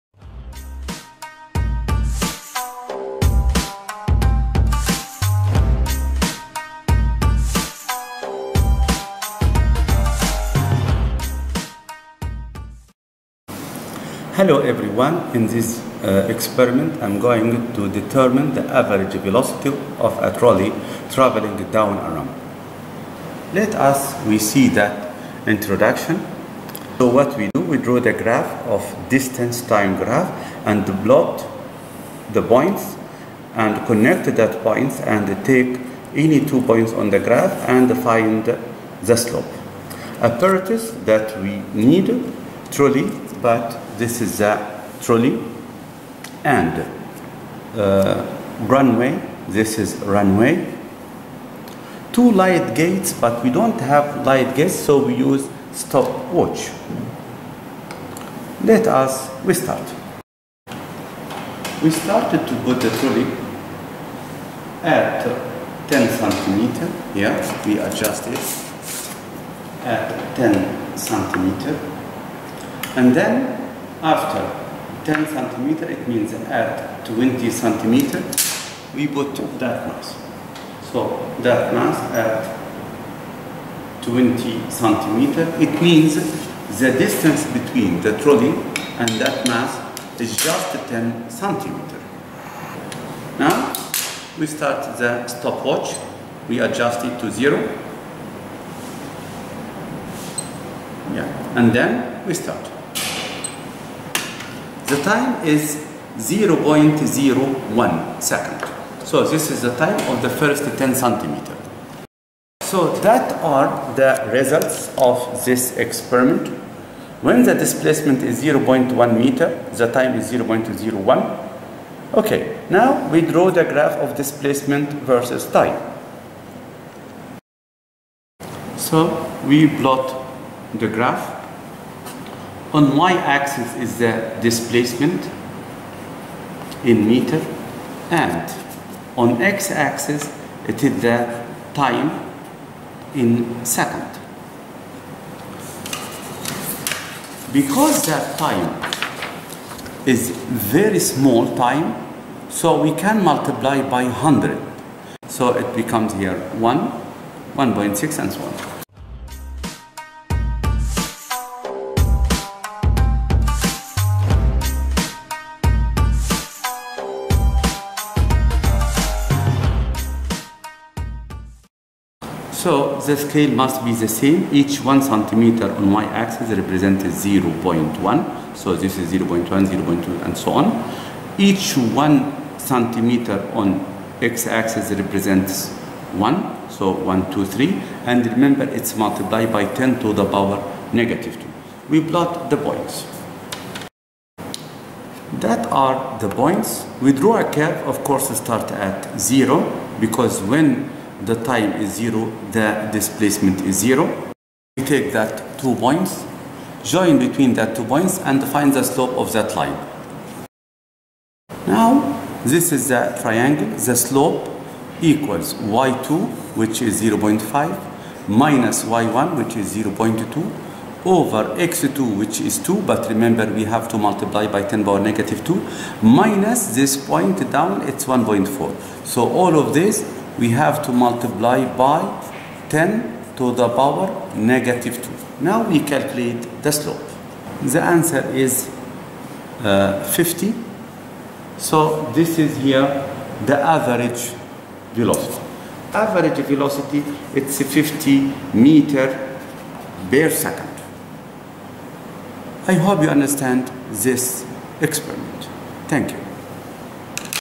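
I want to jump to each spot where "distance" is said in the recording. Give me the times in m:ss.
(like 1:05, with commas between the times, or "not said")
0:29, 1:26.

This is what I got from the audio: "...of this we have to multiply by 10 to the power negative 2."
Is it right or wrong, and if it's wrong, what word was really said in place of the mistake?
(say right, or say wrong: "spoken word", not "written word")
right.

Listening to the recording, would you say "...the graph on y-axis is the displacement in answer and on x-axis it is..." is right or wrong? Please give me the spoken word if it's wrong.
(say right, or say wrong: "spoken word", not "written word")
wrong: "meter", not "answer".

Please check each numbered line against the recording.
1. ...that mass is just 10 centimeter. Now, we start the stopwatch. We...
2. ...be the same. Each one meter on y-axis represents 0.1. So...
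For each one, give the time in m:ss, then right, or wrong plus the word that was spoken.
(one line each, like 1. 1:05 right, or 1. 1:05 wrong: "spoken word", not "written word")
1. 1:29 right
2. 2:53 wrong: "centimeter", not "meter".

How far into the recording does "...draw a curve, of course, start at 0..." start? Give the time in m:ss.
3:17.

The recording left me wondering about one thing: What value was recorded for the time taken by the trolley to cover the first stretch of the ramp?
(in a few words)
0.01 second.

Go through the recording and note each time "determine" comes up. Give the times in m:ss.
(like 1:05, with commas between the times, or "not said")
0:17.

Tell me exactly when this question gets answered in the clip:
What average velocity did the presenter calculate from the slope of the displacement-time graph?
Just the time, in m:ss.
4:07.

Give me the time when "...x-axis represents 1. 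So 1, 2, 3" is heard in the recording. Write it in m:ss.
3:04.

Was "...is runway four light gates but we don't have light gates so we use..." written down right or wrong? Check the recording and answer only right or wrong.
wrong.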